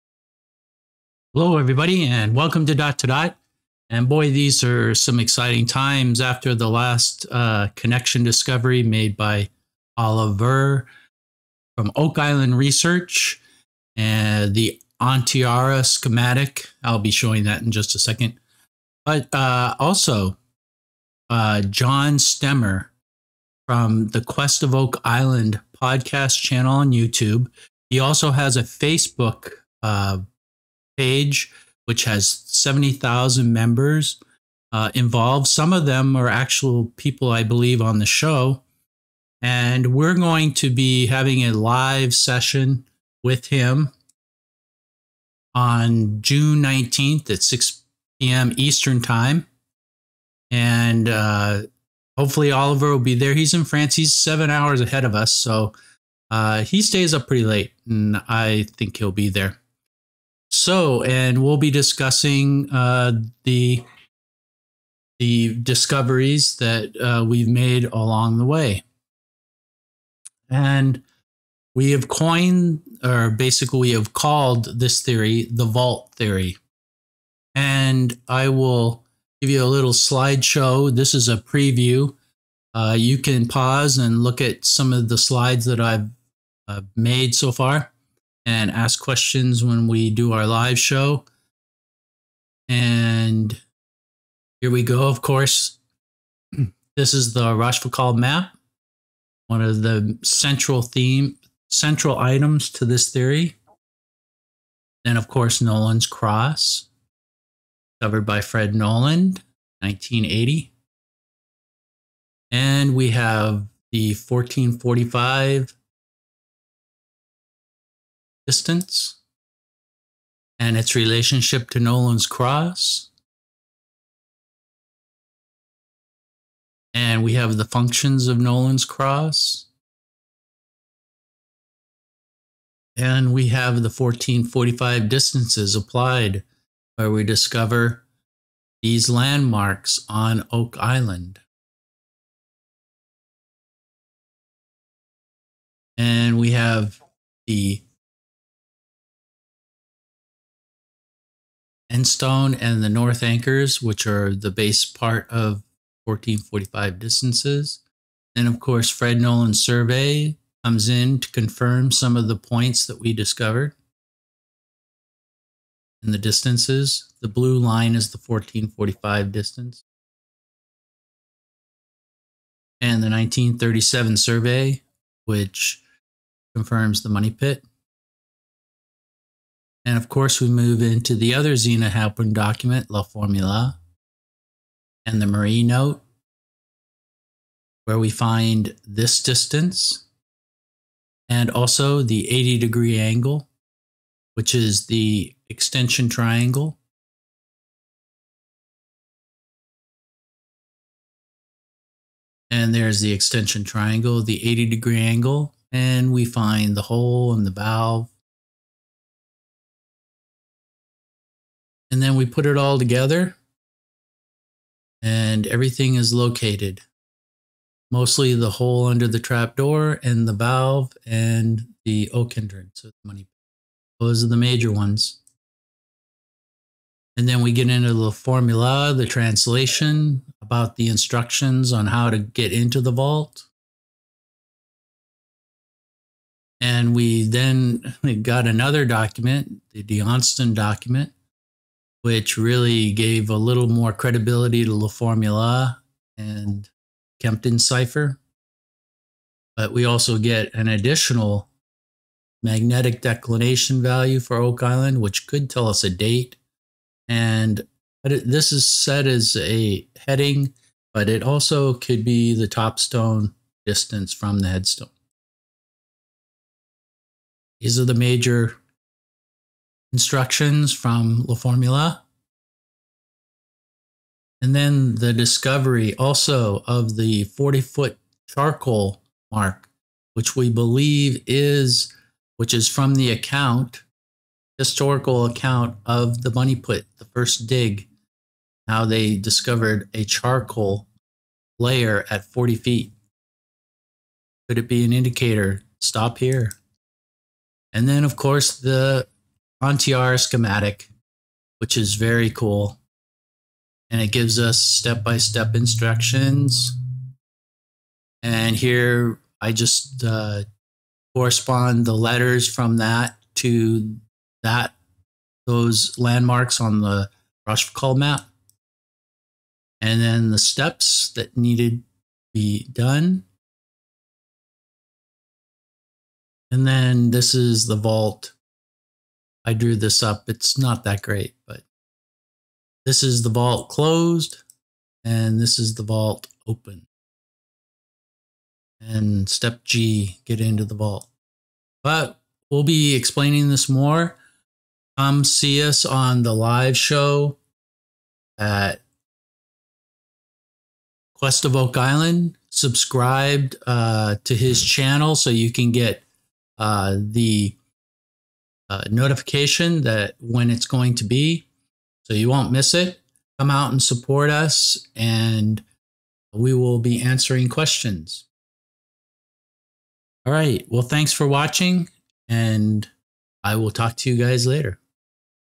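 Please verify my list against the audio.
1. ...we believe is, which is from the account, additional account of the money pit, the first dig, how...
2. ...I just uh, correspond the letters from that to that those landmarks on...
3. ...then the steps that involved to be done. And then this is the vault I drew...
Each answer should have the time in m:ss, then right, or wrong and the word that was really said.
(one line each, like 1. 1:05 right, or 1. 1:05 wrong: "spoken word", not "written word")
1. 4:40 wrong: "historical", not "additional"
2. 5:09 right
3. 5:20 wrong: "needed", not "involved".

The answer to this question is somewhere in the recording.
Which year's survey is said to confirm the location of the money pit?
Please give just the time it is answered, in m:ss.
2:53.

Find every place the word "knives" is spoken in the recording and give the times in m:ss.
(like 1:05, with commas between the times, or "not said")
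not said.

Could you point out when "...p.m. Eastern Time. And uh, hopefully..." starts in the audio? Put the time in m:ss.
0:48.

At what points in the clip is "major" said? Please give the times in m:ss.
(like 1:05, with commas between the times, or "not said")
3:44, 4:27.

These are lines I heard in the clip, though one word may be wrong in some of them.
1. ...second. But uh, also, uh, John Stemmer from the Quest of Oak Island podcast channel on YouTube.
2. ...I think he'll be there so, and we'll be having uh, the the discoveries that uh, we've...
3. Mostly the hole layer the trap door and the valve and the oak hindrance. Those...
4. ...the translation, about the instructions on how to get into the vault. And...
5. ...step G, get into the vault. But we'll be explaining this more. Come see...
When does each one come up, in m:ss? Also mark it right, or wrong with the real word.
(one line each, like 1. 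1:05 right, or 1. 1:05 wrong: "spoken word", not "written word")
1. 0:17 right
2. 0:58 wrong: "discussing", not "having"
3. 3:37 wrong: "under", not "layer"
4. 3:48 right
5. 5:39 right.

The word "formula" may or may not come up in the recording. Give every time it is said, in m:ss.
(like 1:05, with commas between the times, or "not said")
3:03, 3:48, 4:04, 4:31.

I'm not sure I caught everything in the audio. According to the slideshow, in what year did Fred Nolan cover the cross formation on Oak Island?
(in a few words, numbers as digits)
1980.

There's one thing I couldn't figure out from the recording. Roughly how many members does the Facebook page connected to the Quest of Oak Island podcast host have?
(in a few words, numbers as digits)
70,000.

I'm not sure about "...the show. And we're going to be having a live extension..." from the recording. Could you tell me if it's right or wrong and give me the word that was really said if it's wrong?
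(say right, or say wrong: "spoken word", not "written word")
wrong: "session", not "extension".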